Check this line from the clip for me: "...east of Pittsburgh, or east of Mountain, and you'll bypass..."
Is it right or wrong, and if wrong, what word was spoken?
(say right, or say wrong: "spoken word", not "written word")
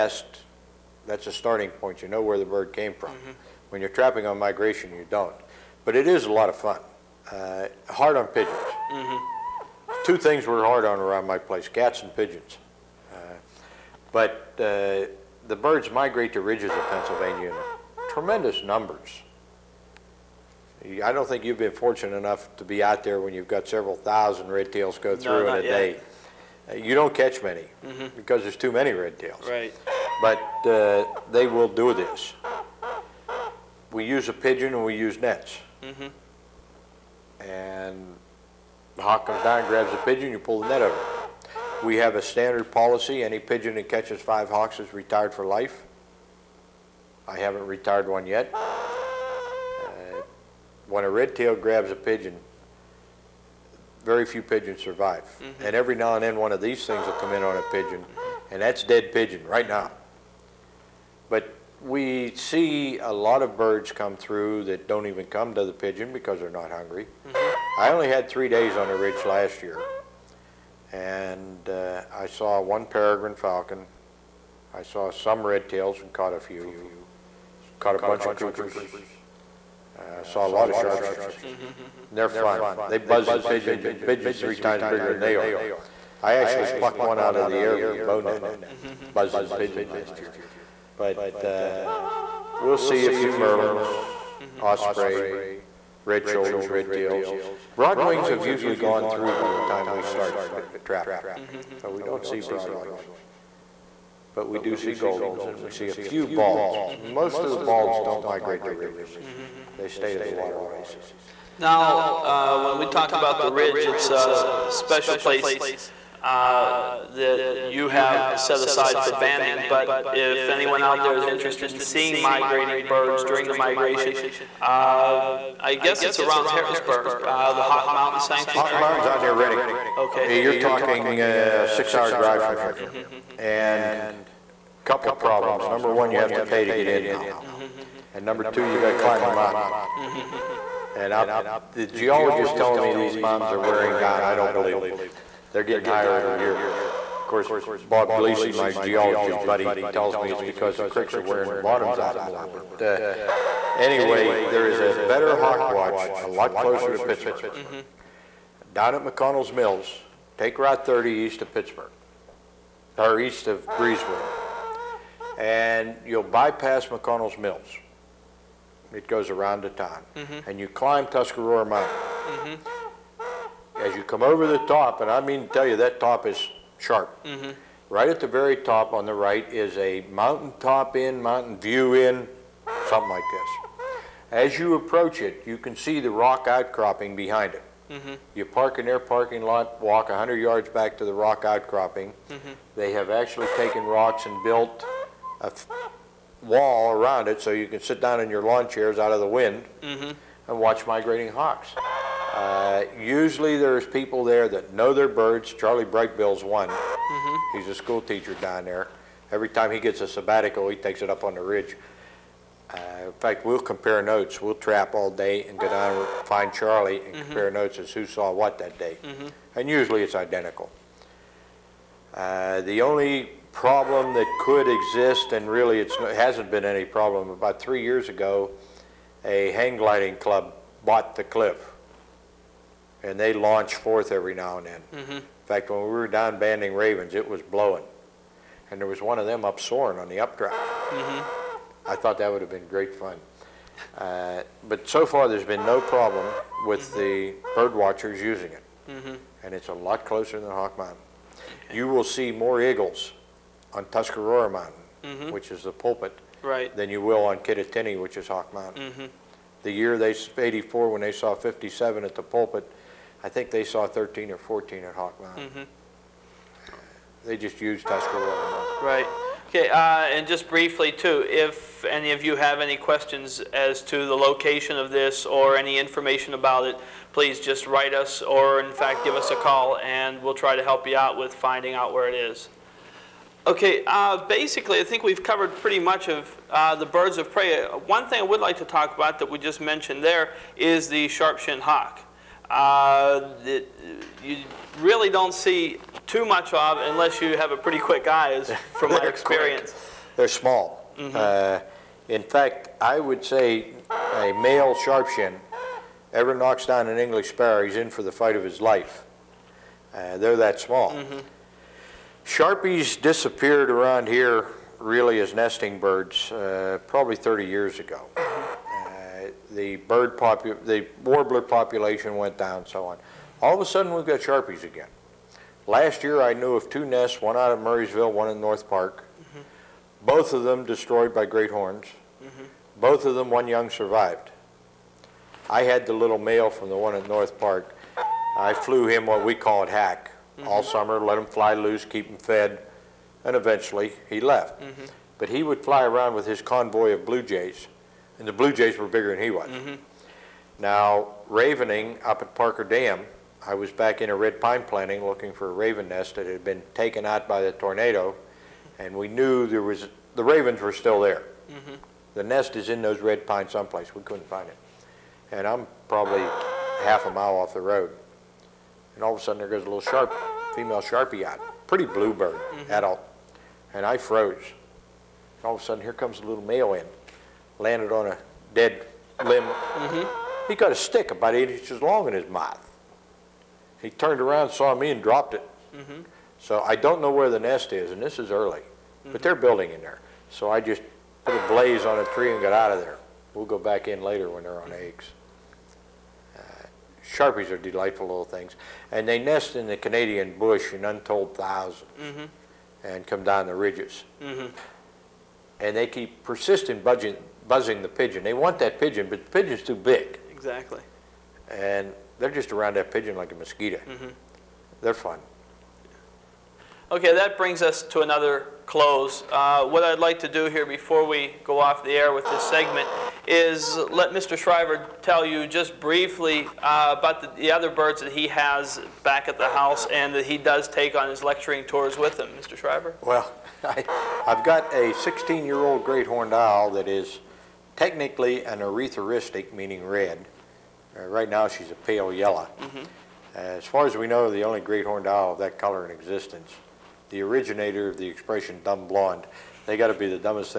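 wrong: "Breezewood", not "Mountain".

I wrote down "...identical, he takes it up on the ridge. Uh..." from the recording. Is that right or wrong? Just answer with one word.
wrong.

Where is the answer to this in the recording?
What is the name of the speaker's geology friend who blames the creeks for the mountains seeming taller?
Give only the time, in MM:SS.
02:27.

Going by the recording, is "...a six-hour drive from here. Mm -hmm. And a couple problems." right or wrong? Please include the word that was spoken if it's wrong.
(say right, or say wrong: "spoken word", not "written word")
right.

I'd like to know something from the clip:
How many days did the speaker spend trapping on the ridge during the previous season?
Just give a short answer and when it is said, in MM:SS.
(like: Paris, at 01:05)
3, at 01:08.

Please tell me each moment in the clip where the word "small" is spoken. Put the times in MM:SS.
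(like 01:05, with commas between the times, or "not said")
05:00, 05:10.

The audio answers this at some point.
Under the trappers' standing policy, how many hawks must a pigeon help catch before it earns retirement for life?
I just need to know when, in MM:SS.
00:44.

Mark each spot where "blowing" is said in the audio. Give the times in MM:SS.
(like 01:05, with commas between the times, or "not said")
03:57.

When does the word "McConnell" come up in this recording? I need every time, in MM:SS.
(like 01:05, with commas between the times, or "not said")
02:39, 02:46.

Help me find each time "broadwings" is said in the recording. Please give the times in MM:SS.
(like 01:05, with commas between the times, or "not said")
01:37, 01:42.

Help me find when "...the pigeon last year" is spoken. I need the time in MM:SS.
01:29.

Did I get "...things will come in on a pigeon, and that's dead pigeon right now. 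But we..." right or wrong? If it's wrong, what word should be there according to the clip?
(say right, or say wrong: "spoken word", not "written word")
right.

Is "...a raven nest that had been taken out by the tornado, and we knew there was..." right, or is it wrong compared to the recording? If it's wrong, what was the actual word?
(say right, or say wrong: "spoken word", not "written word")
right.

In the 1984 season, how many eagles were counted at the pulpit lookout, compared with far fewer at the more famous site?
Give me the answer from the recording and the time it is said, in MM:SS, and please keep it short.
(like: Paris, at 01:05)
57, at 04:21.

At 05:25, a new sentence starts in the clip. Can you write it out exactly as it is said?
Last year I knew of two nests, one out of Murrysville, one in North Park.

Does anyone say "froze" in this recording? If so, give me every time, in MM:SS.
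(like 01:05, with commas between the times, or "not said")
06:13.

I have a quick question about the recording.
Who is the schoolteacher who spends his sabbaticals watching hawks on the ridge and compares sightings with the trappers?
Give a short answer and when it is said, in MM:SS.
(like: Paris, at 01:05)
Charlie Brightbill, at 03:25.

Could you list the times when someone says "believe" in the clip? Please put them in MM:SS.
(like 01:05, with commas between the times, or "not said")
02:24.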